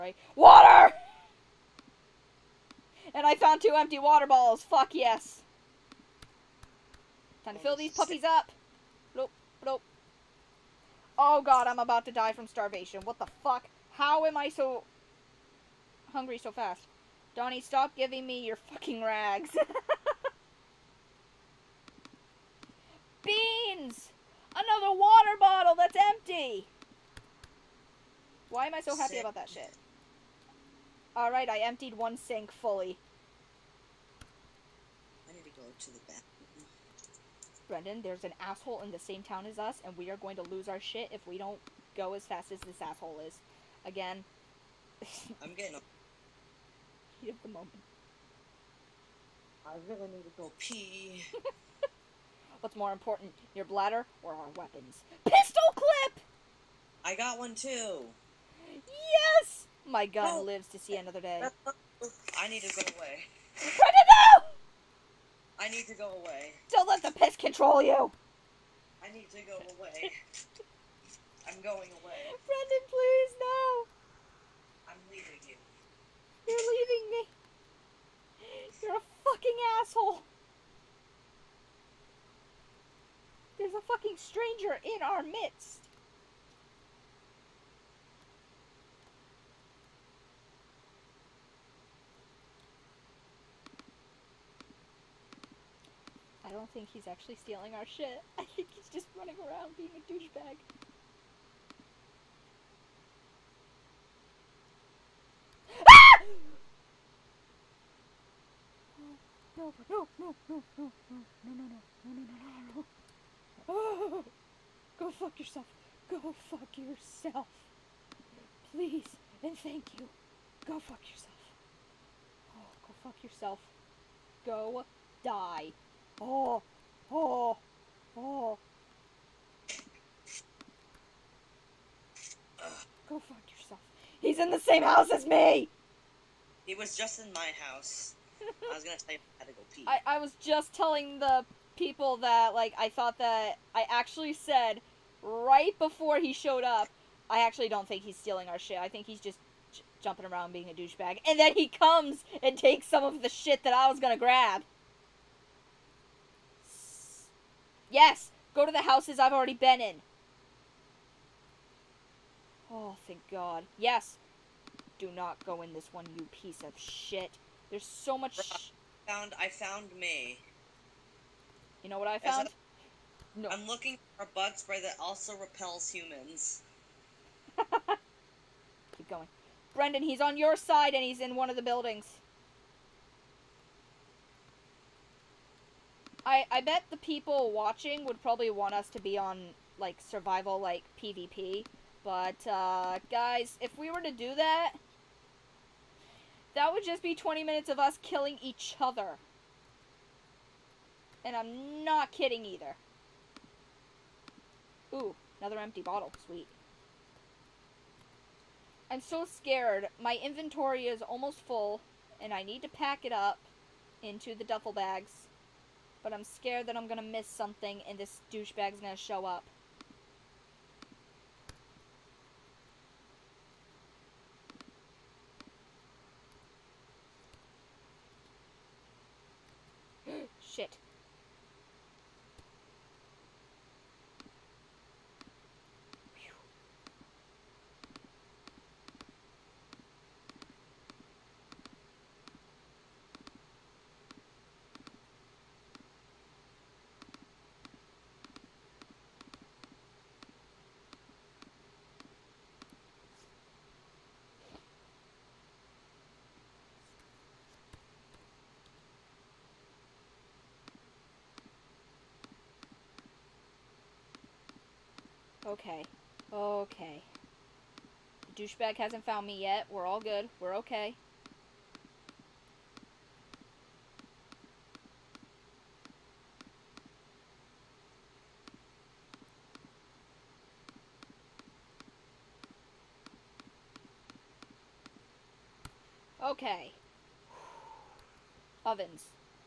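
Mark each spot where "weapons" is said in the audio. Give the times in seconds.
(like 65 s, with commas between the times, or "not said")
54 s.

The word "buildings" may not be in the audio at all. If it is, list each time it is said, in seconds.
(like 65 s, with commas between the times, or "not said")
181 s.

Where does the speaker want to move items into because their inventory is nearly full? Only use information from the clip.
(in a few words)
Duffel bags.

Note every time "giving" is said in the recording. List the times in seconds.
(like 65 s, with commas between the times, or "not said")
17 s.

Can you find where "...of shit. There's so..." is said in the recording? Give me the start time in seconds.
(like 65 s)
166 s.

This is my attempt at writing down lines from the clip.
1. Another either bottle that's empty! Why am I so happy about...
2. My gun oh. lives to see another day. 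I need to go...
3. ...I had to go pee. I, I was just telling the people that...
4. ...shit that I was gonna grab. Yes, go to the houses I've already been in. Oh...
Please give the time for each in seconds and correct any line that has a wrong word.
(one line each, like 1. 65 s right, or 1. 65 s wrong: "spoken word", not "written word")
1. 24 s wrong: "water", not "either"
2. 59 s right
3. 139 s right
4. 153 s right.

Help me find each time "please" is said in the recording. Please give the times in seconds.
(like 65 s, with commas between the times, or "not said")
72 s, 118 s.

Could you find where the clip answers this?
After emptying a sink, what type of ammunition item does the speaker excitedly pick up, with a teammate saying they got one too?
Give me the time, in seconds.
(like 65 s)
55 s.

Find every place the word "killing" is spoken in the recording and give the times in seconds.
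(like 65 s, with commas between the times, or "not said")
198 s.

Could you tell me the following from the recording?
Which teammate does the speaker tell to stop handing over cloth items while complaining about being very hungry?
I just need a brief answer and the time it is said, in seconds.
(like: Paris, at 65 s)
Donnie, at 17 s.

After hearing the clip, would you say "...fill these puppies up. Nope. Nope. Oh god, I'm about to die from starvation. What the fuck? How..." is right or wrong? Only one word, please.
right.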